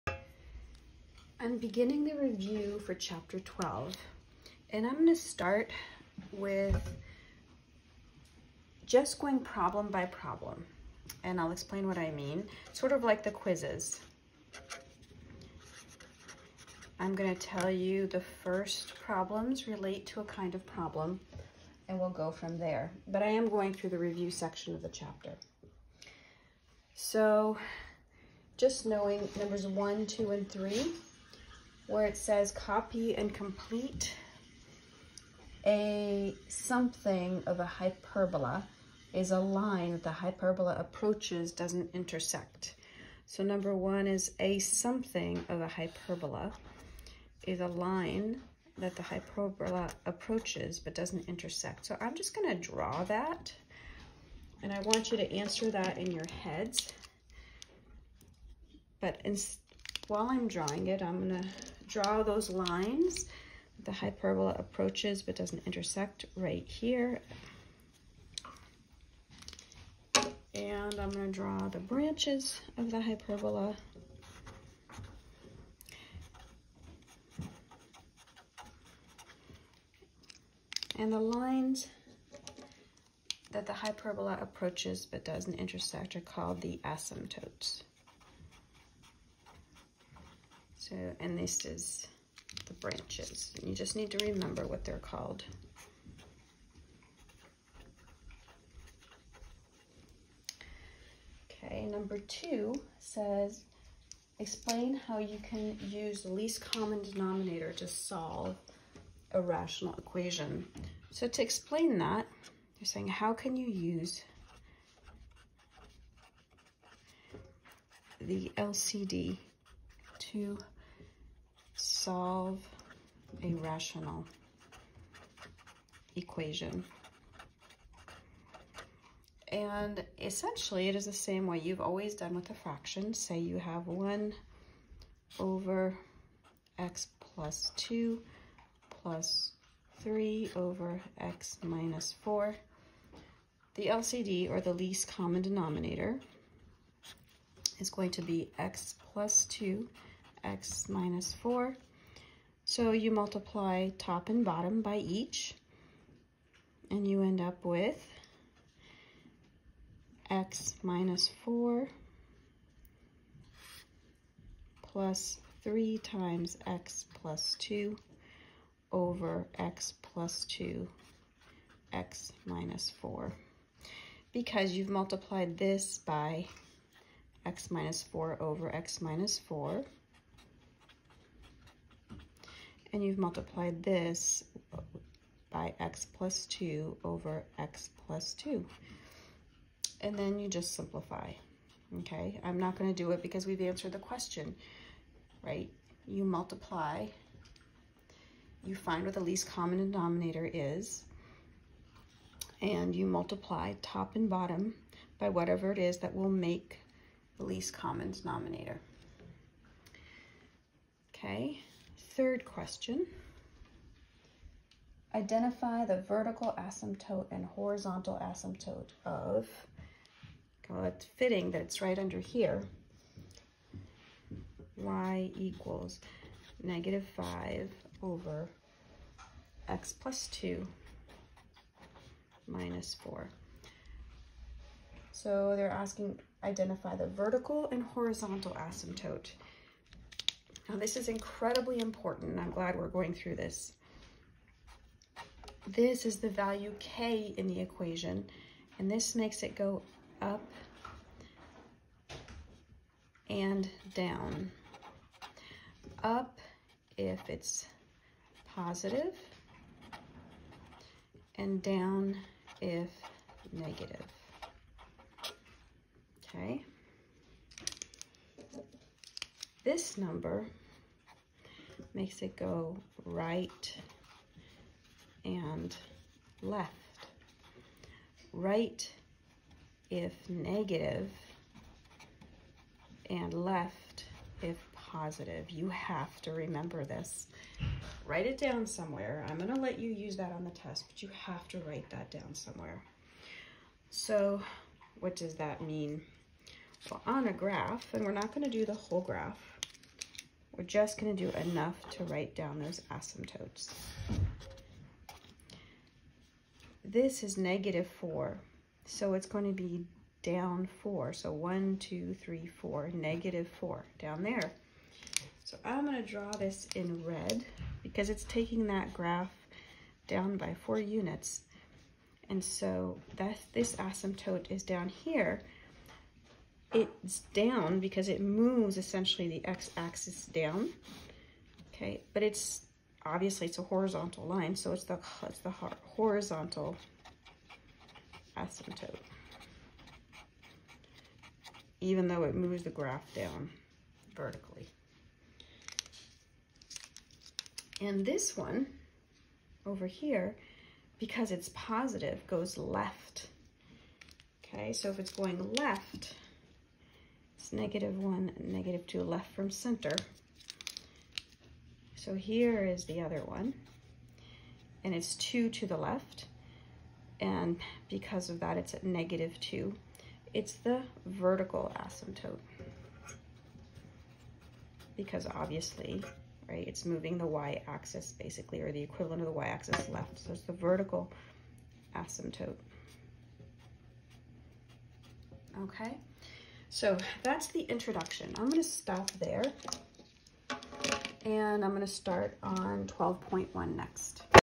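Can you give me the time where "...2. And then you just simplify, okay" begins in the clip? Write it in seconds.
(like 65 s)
188 s.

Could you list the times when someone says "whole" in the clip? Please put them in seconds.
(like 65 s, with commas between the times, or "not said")
298 s.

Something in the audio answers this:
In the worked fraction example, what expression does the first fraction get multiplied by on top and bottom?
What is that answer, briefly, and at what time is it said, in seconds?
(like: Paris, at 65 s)
x minus 4 over x minus 4, at 177 s.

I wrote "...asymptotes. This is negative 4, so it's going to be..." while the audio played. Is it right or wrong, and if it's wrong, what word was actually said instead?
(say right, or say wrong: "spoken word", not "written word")
right.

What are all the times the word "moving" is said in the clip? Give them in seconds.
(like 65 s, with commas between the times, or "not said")
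376 s.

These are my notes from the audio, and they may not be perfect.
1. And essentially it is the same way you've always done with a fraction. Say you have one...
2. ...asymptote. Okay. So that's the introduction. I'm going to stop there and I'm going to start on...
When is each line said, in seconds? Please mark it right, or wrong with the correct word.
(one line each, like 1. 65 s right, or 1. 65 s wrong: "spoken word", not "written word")
1. 129 s right
2. 381 s right.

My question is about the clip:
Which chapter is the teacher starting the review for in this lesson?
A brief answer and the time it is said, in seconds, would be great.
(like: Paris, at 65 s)
12, at 2 s.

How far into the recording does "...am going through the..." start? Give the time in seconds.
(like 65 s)
23 s.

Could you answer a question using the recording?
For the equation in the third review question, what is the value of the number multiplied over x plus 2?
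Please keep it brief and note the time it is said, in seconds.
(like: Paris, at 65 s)
-5, at 226 s.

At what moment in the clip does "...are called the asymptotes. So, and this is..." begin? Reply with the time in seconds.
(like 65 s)
86 s.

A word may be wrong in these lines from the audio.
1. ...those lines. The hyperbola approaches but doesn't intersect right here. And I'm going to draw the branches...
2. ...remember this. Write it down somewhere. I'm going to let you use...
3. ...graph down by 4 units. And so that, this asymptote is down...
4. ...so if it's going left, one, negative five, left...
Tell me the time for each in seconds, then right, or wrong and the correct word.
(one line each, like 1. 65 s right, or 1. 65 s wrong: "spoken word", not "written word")
1. 62 s right
2. 286 s right
3. 318 s right
4. 354 s wrong: "two", not "five".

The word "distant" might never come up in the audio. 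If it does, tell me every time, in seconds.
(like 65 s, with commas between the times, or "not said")
not said.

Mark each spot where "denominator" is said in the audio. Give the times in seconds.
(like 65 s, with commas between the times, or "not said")
107 s, 145 s, 199 s, 208 s.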